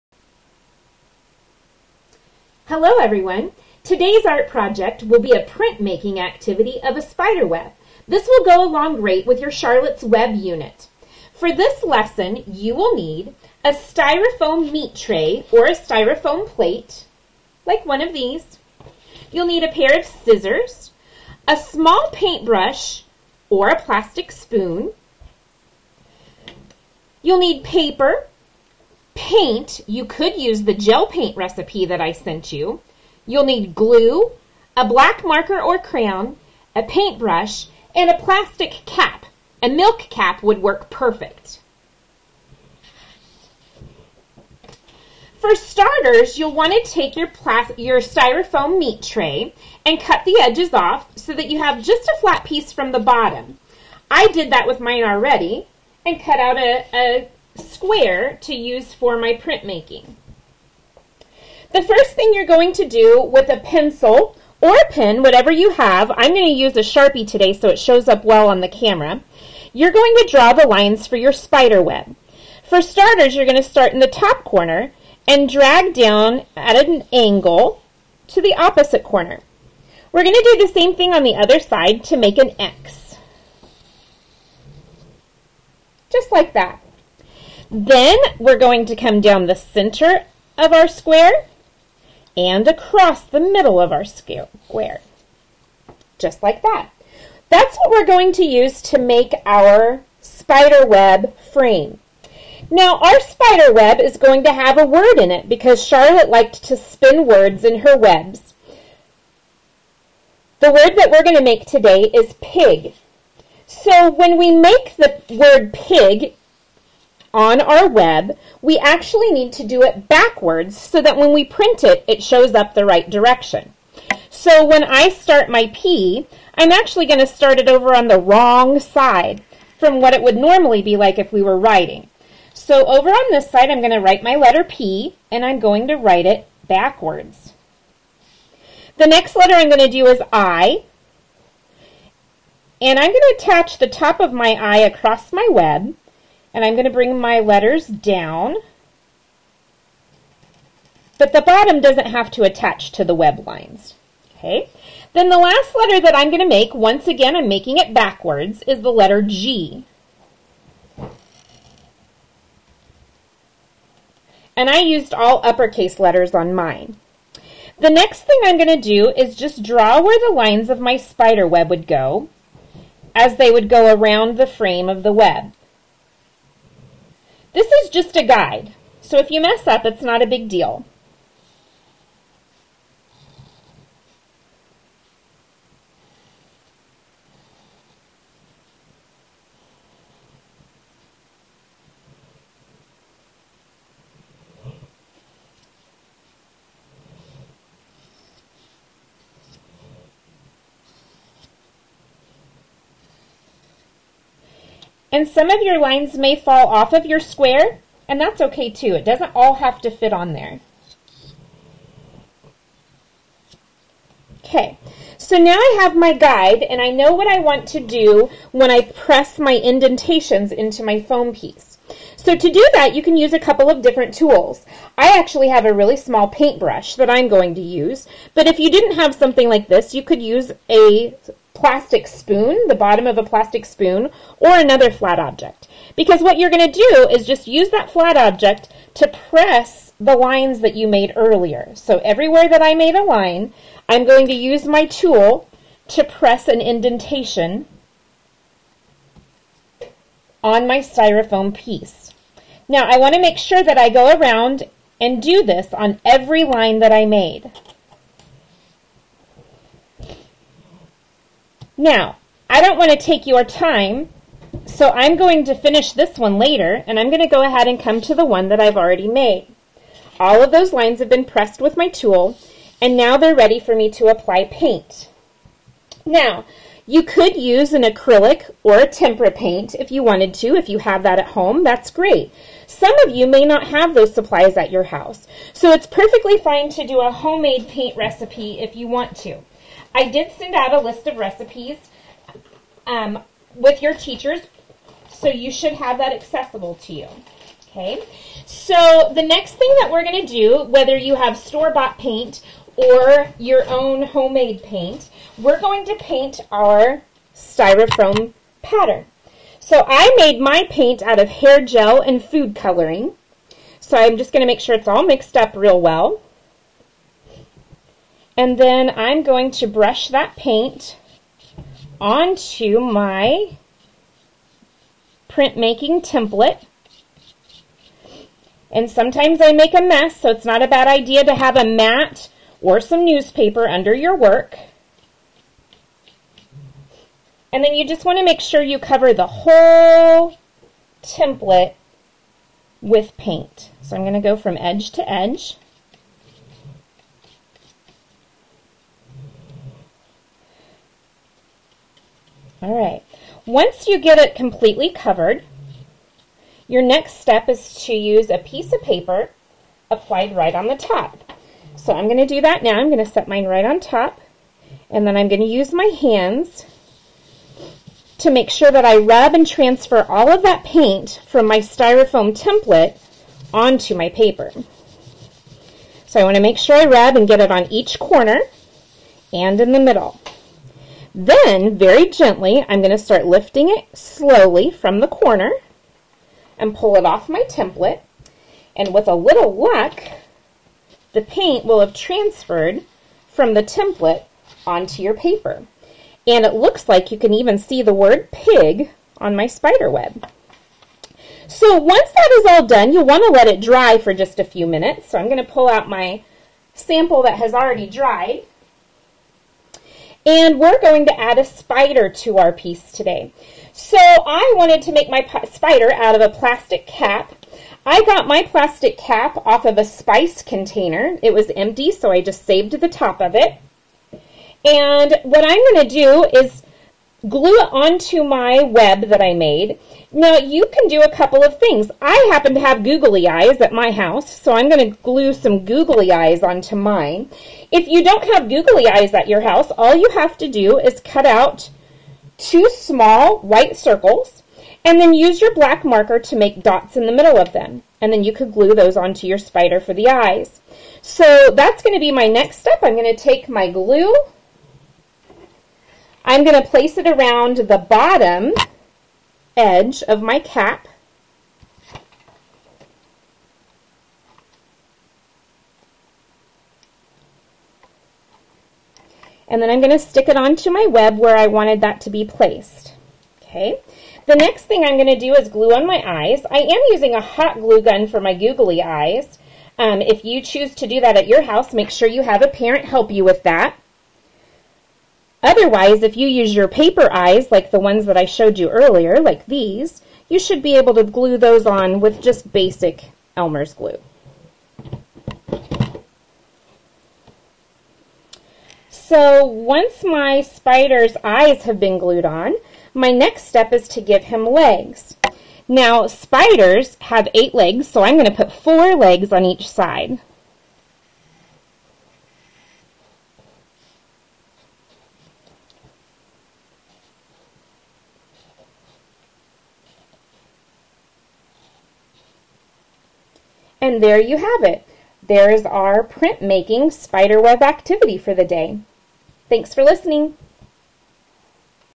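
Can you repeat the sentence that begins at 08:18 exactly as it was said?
So once my spider's eyes have been glued on, my next step is to give him legs.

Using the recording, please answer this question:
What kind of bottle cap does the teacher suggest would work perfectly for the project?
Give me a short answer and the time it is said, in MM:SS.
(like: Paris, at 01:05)
A milk cap, at 00:39.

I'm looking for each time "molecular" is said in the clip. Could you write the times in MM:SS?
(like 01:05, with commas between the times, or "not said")
not said.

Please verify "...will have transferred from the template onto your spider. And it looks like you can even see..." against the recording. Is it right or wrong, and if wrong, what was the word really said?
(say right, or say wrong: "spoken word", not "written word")
wrong: "paper", not "spider".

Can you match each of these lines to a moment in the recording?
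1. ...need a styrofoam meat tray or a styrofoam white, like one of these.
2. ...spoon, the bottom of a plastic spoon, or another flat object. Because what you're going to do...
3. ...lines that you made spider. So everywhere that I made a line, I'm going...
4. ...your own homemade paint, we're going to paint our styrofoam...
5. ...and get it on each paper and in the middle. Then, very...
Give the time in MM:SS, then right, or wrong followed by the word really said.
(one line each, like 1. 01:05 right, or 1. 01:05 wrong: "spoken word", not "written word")
1. 00:12 wrong: "plate", not "white"
2. 03:52 right
3. 04:00 wrong: "earlier", not "spider"
4. 05:03 right
5. 06:17 wrong: "corner", not "paper".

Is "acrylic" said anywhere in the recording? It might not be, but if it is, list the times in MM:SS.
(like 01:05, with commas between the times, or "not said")
04:37.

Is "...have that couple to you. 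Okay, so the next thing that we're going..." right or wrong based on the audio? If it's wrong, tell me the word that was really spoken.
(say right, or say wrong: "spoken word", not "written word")
wrong: "accessible", not "couple".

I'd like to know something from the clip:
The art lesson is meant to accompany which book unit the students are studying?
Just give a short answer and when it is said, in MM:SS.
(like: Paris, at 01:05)
Charlotte's Web, at 00:09.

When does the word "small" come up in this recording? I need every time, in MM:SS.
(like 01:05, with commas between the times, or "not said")
00:21, 03:45, 07:22.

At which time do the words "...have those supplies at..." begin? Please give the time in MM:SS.
04:43.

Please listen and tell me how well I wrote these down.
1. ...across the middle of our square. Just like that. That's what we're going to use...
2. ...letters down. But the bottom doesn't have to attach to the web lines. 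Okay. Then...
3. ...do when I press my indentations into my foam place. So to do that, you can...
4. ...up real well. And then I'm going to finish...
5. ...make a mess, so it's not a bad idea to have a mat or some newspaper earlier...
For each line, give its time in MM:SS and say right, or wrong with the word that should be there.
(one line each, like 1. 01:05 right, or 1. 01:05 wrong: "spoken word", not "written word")
1. 01:32 right
2. 02:27 right
3. 03:37 wrong: "piece", not "place"
4. 05:15 wrong: "brush", not "finish"
5. 05:29 wrong: "under", not "earlier".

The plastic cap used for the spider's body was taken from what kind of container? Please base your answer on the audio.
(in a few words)
A spice container.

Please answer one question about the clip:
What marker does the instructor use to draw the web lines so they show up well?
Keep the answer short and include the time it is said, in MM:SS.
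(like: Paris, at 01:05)
A Sharpie, at 01:06.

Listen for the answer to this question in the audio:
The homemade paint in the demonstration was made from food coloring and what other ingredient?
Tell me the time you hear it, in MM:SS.
05:11.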